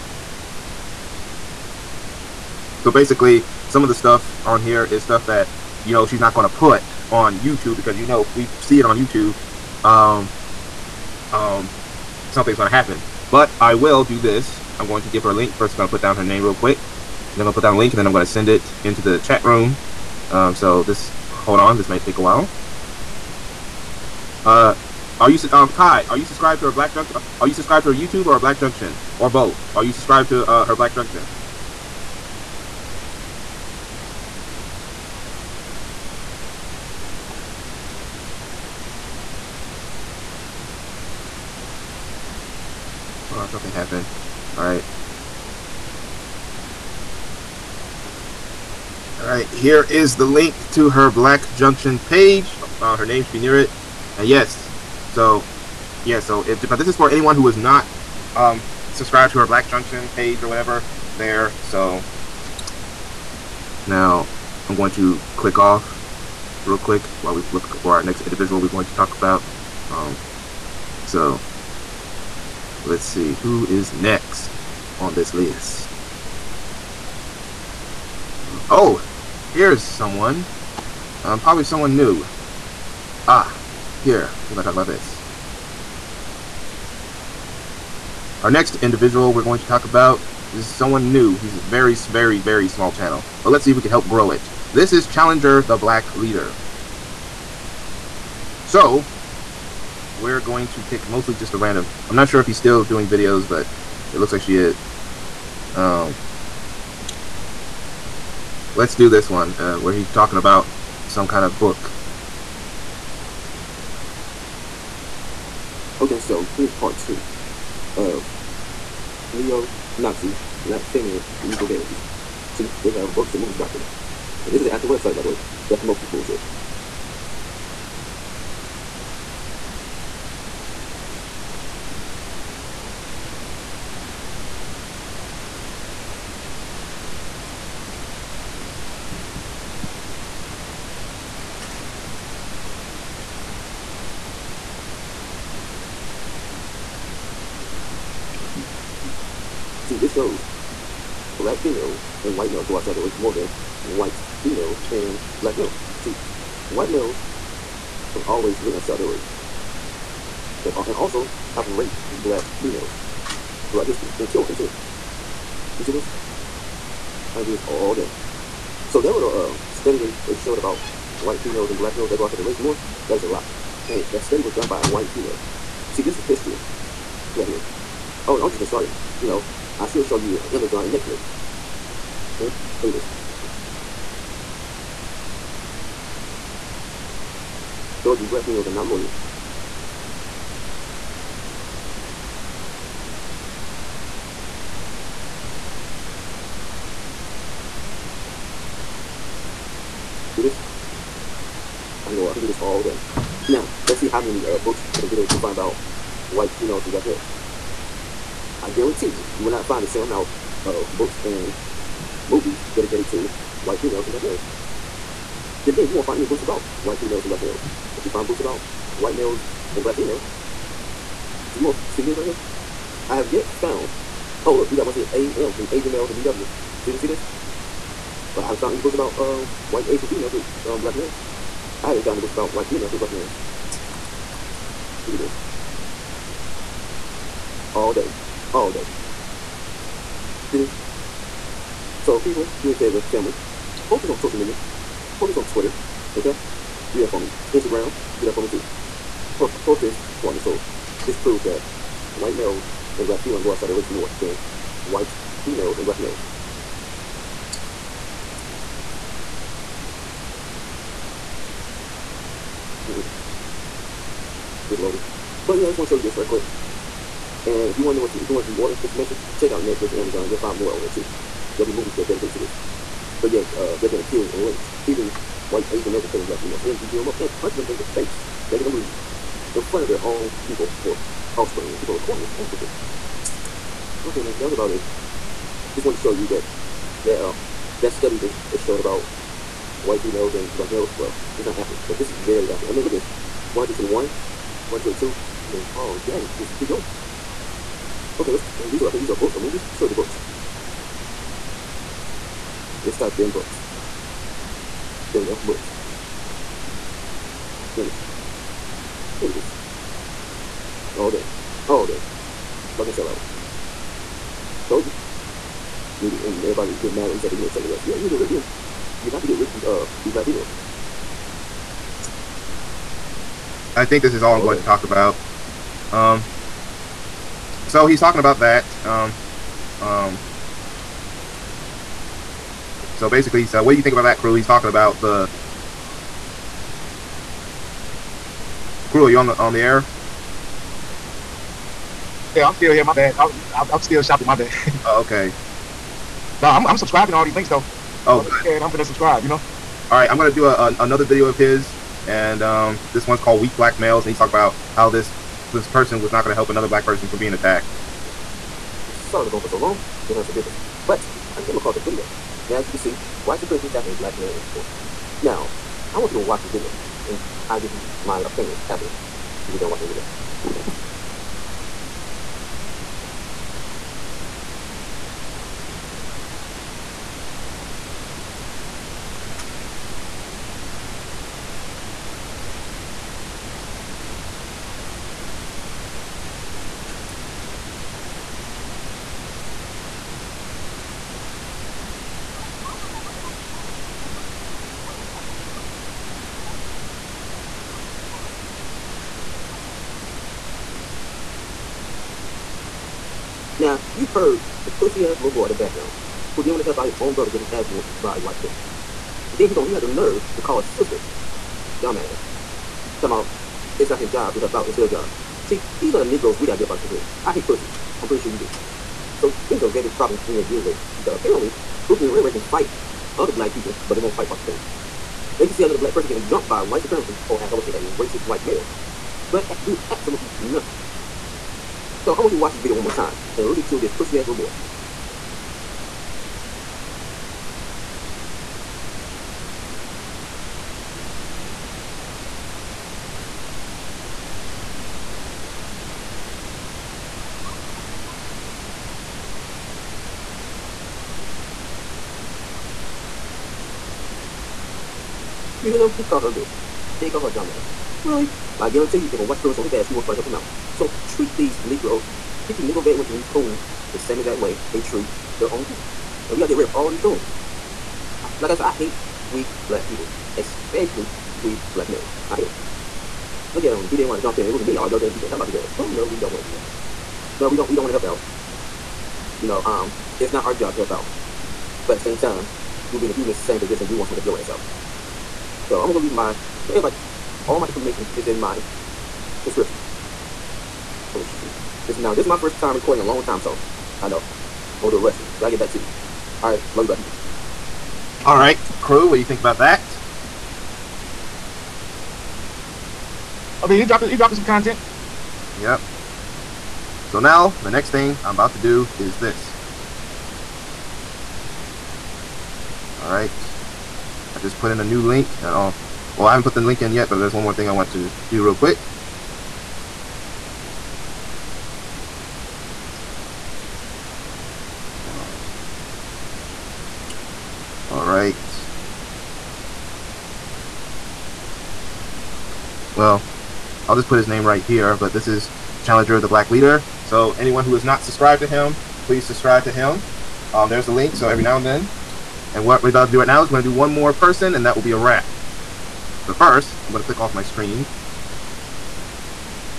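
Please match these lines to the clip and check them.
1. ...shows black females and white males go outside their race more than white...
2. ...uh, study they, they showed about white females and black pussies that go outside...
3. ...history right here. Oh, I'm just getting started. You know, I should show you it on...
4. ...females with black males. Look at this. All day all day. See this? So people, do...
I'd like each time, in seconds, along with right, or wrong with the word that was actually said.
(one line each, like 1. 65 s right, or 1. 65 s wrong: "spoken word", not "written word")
1. 150 s right
2. 169 s wrong: "males", not "pussies"
3. 176 s right
4. 232 s right.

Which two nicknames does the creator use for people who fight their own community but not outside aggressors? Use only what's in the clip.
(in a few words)
Pookie and Ray Ray.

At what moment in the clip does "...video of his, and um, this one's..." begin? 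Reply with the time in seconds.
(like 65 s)
351 s.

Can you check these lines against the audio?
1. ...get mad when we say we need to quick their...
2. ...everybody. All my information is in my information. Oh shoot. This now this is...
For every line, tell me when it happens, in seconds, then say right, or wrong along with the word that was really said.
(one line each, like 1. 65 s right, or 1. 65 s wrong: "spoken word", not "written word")
1. 316 s wrong: "check", not "quick"
2. 486 s wrong: "subscription", not "information".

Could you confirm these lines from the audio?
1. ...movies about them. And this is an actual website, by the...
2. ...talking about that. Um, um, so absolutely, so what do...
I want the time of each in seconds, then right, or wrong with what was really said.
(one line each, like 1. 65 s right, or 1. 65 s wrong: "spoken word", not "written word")
1. 123 s right
2. 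328 s wrong: "basically", not "absolutely".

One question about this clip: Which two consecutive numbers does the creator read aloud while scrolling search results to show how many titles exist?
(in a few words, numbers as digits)
121, 122.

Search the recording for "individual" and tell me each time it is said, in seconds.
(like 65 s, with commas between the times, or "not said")
68 s, 88 s.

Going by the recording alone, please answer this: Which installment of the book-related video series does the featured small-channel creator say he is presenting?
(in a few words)
Part two.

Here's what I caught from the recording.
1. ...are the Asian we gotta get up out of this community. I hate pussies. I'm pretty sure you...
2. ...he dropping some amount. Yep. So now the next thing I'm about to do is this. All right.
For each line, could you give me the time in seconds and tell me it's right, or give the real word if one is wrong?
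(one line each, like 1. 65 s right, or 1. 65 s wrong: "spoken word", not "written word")
1. 415 s wrong: "Negroes", not "Asian"
2. 504 s wrong: "content", not "amount".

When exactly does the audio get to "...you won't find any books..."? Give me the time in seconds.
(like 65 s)
215 s.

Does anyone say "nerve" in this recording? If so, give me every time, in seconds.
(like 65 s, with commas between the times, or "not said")
409 s.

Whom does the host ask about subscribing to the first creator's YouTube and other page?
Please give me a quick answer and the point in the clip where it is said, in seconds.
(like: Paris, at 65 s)
Kai, at 25 s.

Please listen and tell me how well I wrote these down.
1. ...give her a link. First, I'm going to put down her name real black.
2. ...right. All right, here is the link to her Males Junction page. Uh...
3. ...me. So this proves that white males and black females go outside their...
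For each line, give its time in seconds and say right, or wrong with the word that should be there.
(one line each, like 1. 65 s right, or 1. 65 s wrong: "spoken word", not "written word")
1. 15 s wrong: "quick", not "black"
2. 44 s wrong: "Black", not "Males"
3. 250 s right.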